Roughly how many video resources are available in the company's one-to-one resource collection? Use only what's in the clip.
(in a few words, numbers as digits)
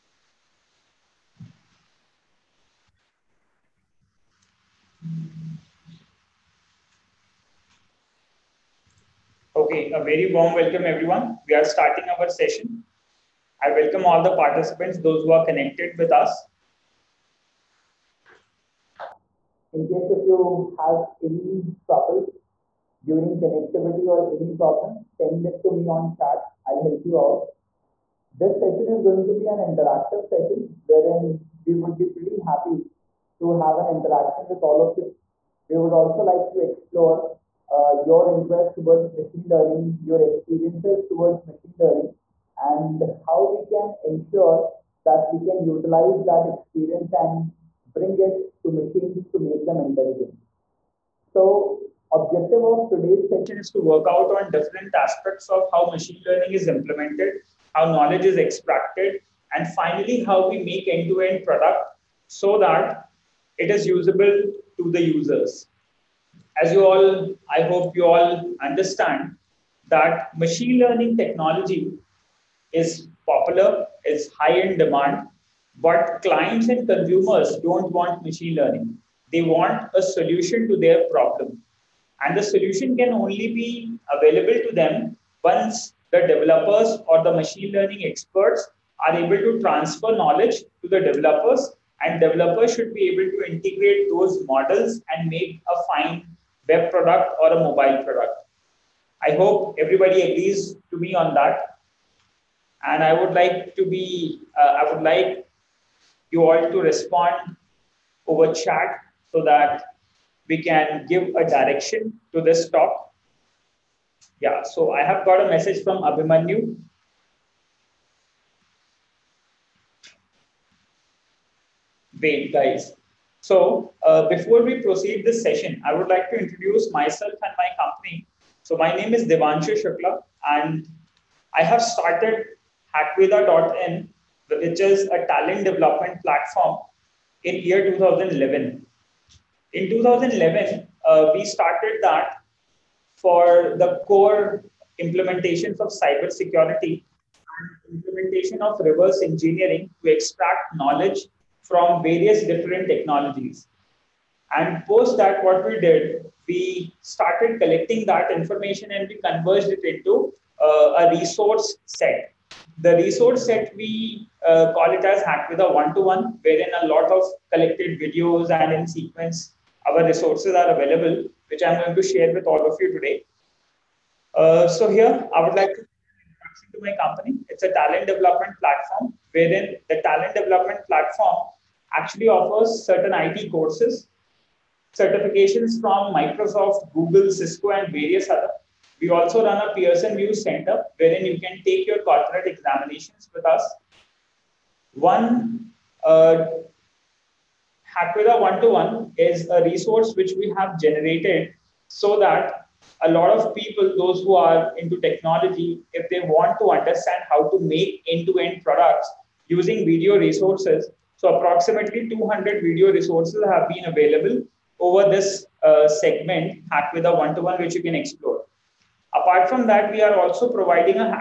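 200.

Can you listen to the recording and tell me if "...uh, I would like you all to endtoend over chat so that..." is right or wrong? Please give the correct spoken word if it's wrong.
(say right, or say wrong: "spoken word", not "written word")
wrong: "respond", not "endtoend".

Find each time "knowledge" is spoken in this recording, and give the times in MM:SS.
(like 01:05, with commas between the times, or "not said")
00:57, 01:30, 02:30.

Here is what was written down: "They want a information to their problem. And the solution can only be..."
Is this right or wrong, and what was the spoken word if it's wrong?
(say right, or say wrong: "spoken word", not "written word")
wrong: "solution", not "information".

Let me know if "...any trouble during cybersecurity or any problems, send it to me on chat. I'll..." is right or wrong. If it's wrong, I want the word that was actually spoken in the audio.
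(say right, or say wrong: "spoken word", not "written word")
wrong: "connectivity", not "cybersecurity".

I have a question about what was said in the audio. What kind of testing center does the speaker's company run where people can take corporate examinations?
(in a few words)
Pearson VUE Center.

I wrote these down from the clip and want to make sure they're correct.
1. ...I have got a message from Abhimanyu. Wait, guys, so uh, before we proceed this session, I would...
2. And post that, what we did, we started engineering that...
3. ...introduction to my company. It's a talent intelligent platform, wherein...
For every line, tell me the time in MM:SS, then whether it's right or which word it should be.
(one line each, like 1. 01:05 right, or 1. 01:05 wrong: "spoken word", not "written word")
1. 01:54 right
2. 02:34 wrong: "collecting", not "engineering"
3. 02:55 wrong: "development", not "intelligent".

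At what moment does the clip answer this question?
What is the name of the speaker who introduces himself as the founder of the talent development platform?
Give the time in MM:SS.
02:09.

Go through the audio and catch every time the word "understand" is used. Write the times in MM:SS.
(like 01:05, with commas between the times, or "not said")
01:08, 03:26.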